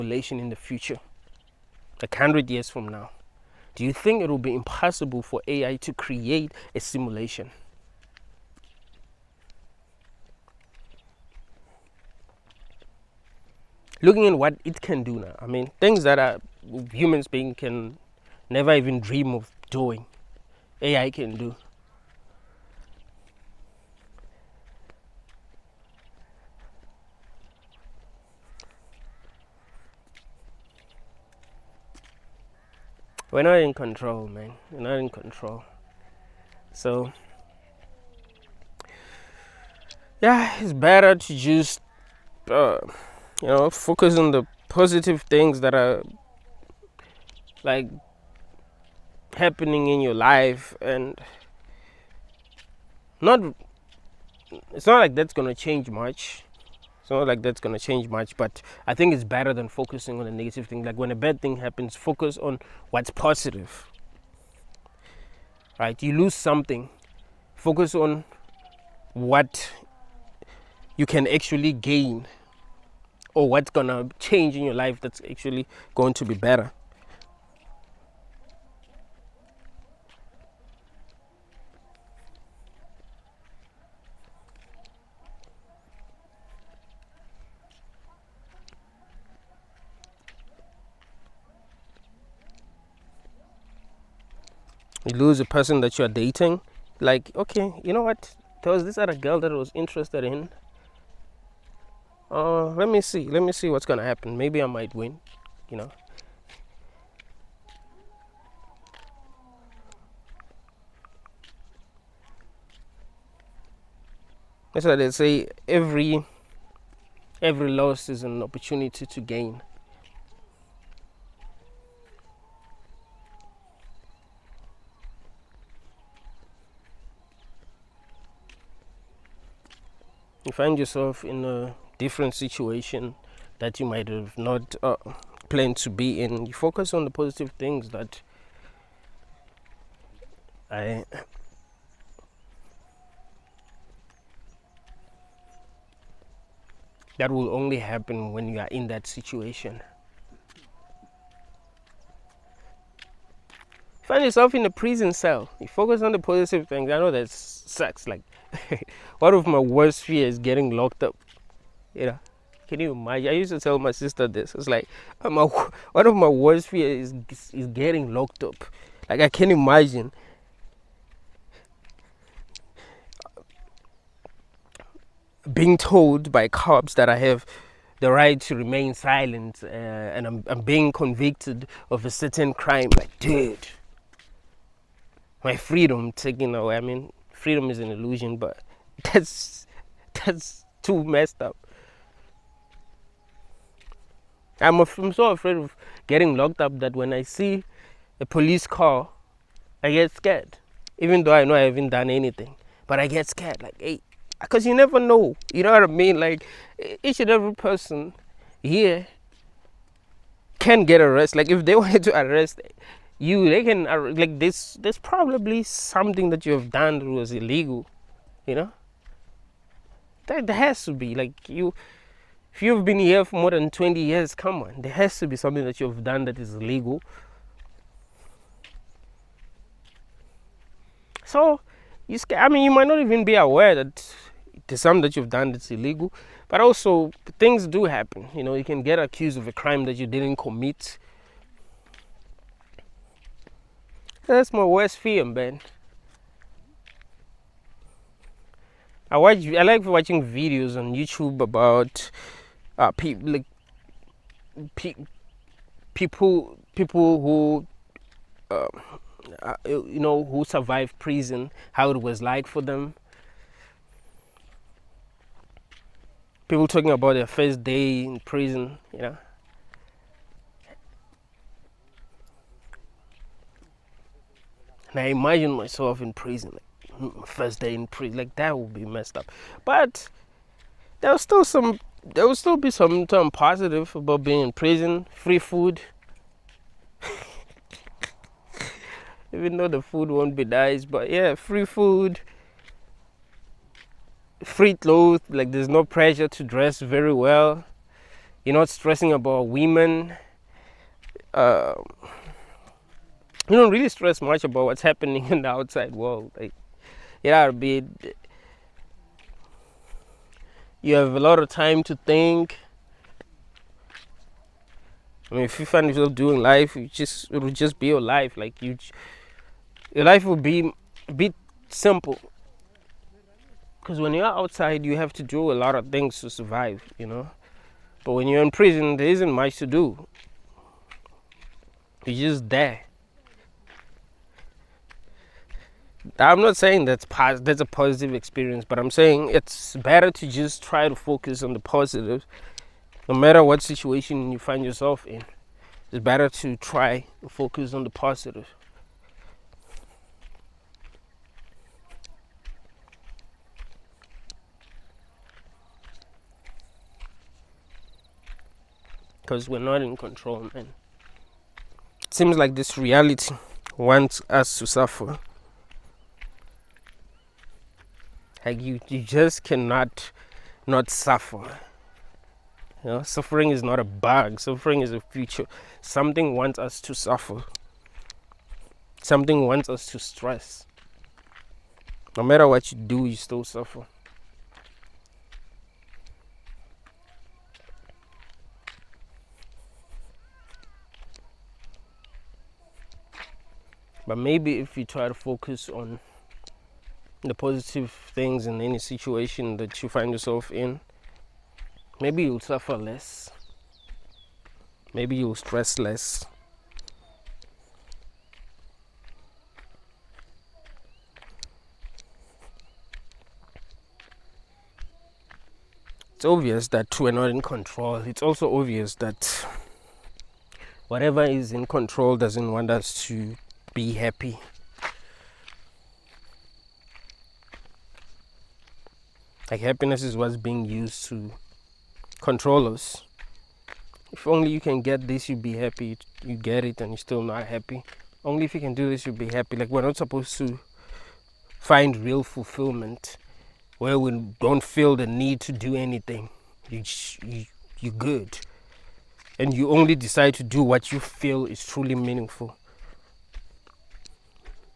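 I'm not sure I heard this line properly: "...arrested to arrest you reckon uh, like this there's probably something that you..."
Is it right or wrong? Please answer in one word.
wrong.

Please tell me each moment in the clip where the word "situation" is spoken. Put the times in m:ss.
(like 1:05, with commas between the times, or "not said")
2:12, 2:29, 5:43, 6:38.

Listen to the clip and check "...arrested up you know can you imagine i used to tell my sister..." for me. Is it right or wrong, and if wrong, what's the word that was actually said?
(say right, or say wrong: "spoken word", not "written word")
wrong: "locked", not "arrested".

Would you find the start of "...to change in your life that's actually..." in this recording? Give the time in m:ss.
1:13.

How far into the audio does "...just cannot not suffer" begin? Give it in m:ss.
6:09.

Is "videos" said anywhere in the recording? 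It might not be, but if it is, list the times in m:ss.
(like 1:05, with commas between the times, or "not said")
4:10.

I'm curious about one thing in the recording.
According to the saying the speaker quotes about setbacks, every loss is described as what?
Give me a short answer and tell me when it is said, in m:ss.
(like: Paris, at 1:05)
An opportunity to gain, at 1:58.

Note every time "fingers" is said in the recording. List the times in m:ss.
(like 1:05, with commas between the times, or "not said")
not said.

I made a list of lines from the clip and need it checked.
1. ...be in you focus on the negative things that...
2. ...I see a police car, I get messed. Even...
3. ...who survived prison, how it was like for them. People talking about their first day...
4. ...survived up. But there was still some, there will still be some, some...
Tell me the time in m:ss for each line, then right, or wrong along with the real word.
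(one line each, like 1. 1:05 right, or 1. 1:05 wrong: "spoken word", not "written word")
1. 2:15 wrong: "positive", not "negative"
2. 3:17 wrong: "scared", not "messed"
3. 4:20 right
4. 4:38 wrong: "messed", not "survived".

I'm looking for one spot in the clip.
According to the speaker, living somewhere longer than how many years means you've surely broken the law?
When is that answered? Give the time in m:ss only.
3:43.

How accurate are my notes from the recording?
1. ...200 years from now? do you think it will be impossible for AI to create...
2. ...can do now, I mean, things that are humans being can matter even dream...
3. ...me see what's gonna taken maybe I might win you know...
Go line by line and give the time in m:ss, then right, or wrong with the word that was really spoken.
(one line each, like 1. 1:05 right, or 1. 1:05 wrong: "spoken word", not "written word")
1. 0:02 wrong: "100", not "200"
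2. 0:14 wrong: "never", not "matter"
3. 1:43 wrong: "happen", not "taken".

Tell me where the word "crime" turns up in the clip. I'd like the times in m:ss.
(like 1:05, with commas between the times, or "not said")
3:02, 3:59.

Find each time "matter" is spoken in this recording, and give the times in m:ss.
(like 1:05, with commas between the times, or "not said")
5:43, 6:22.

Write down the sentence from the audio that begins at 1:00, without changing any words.
Like when a bad thing happens, focus on what's positive.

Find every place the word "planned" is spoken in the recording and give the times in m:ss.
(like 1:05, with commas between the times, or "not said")
2:15.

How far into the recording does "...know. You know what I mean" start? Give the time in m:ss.
3:24.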